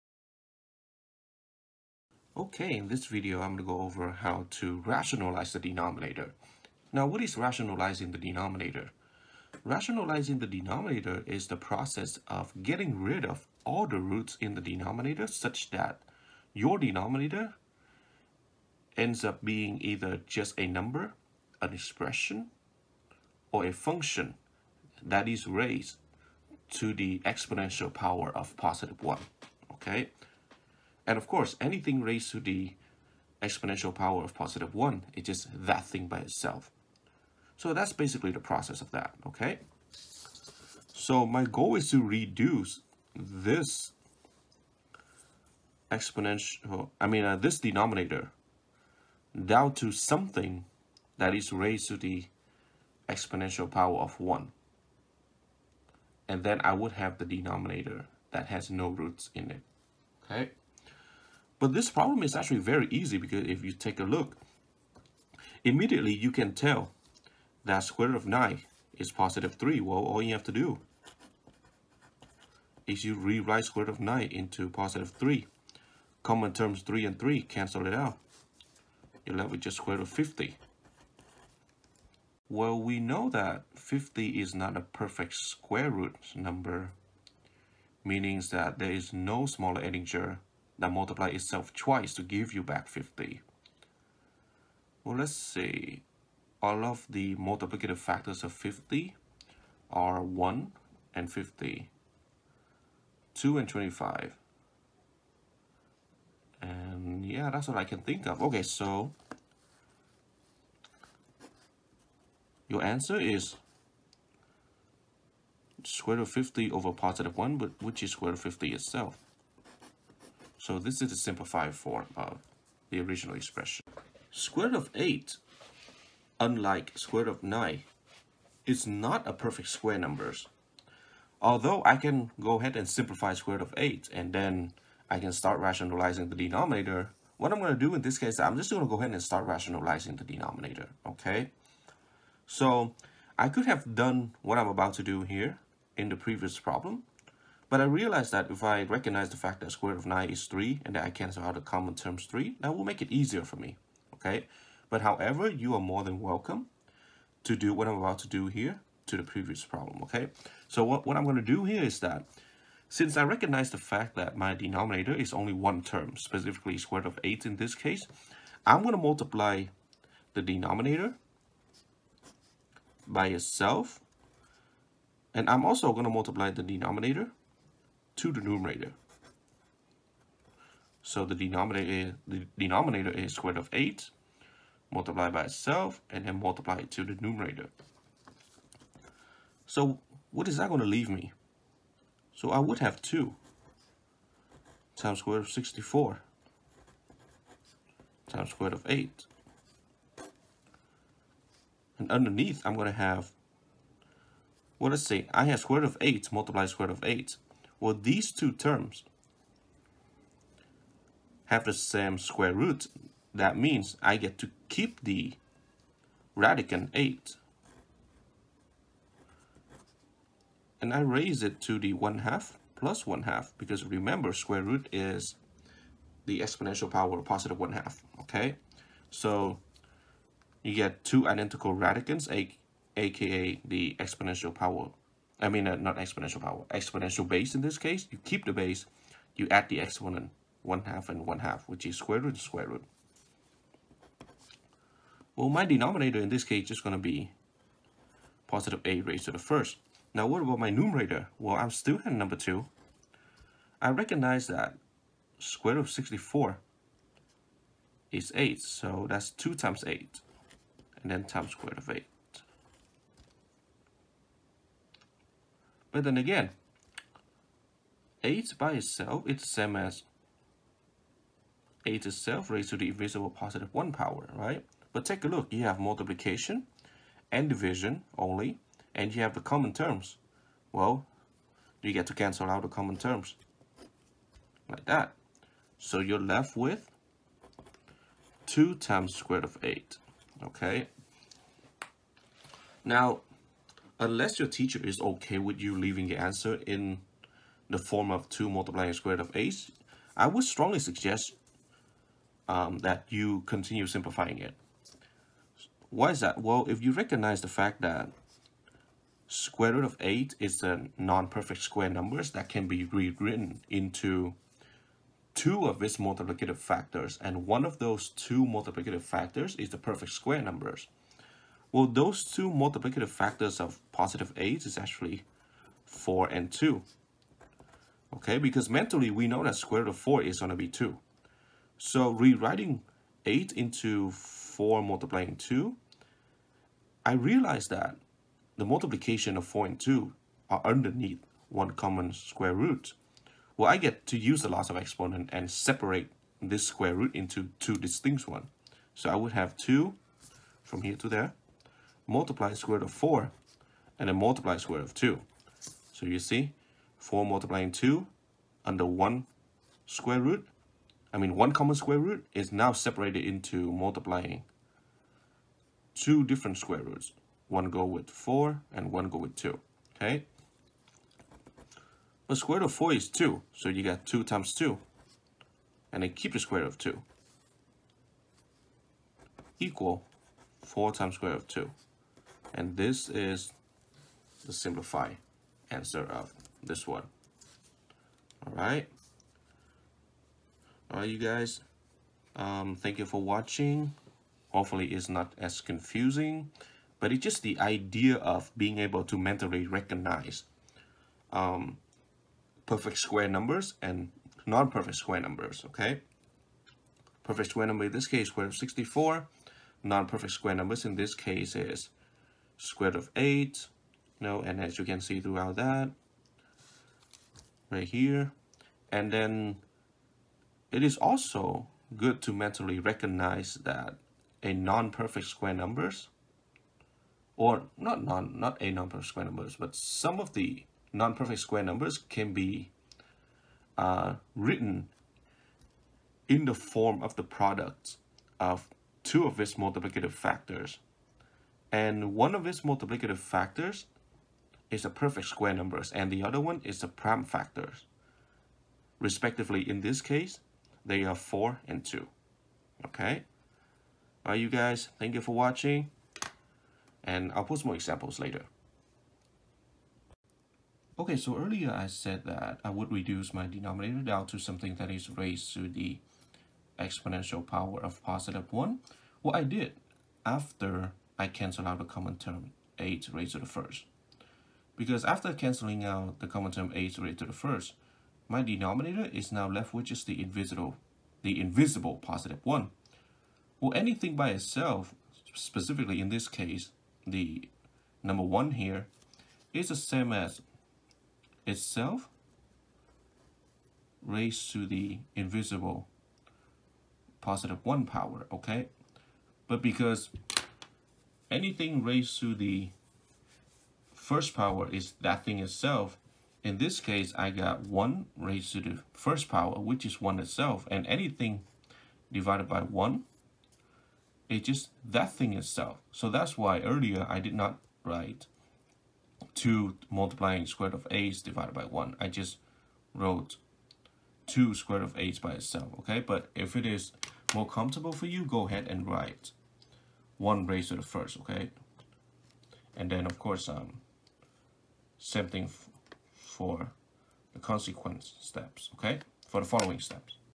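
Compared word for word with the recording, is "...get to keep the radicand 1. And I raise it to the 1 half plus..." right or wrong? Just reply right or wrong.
wrong.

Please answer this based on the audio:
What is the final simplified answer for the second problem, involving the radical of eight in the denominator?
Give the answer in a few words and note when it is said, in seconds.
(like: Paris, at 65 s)
4 times square root of 2, at 380 s.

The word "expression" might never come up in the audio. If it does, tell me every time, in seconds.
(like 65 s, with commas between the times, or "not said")
21 s, 123 s.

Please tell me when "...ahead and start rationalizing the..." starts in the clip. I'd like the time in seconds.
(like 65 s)
138 s.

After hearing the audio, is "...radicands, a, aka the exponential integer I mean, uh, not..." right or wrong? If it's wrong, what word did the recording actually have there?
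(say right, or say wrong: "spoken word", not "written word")
wrong: "power", not "integer".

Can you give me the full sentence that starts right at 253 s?
I recognize that square root of 64 is 8, so that's 2 times 8, and then times square root of 8.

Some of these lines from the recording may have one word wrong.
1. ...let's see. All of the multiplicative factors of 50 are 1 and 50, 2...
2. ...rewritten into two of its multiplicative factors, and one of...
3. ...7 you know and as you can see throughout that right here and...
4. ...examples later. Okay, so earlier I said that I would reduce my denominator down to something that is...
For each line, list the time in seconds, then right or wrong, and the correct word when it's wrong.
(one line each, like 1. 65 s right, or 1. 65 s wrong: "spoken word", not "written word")
1. 95 s right
2. 312 s right
3. 413 s wrong: "8", not "7"
4. 457 s right.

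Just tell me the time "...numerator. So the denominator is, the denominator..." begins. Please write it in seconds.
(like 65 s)
178 s.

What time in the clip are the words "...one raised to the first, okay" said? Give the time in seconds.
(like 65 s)
530 s.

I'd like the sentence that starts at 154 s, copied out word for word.
But however, you are more than welcome to do what I'm about to do here to the previous problem, okay?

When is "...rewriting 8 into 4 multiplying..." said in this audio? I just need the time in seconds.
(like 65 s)
332 s.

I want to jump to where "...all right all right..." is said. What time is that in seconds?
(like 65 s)
388 s.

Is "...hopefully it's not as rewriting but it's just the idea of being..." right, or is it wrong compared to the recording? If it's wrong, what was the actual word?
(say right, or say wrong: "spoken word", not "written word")
wrong: "confusing", not "rewriting".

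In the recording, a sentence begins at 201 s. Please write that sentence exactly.
And underneath, I'm going to have, well, let's say I have square root of 8 multiplied square root of 8.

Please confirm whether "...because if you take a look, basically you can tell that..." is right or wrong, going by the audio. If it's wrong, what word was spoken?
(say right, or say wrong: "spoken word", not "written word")
wrong: "immediately", not "basically".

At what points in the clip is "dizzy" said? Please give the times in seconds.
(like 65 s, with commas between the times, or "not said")
not said.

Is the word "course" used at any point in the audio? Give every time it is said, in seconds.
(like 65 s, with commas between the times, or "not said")
31 s, 533 s.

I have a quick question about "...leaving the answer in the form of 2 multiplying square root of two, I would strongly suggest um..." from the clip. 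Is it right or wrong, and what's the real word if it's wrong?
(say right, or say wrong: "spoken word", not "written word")
wrong: "eight", not "two".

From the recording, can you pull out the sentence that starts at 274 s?
But take a look, you have multiplication and division only, and you have the common terms.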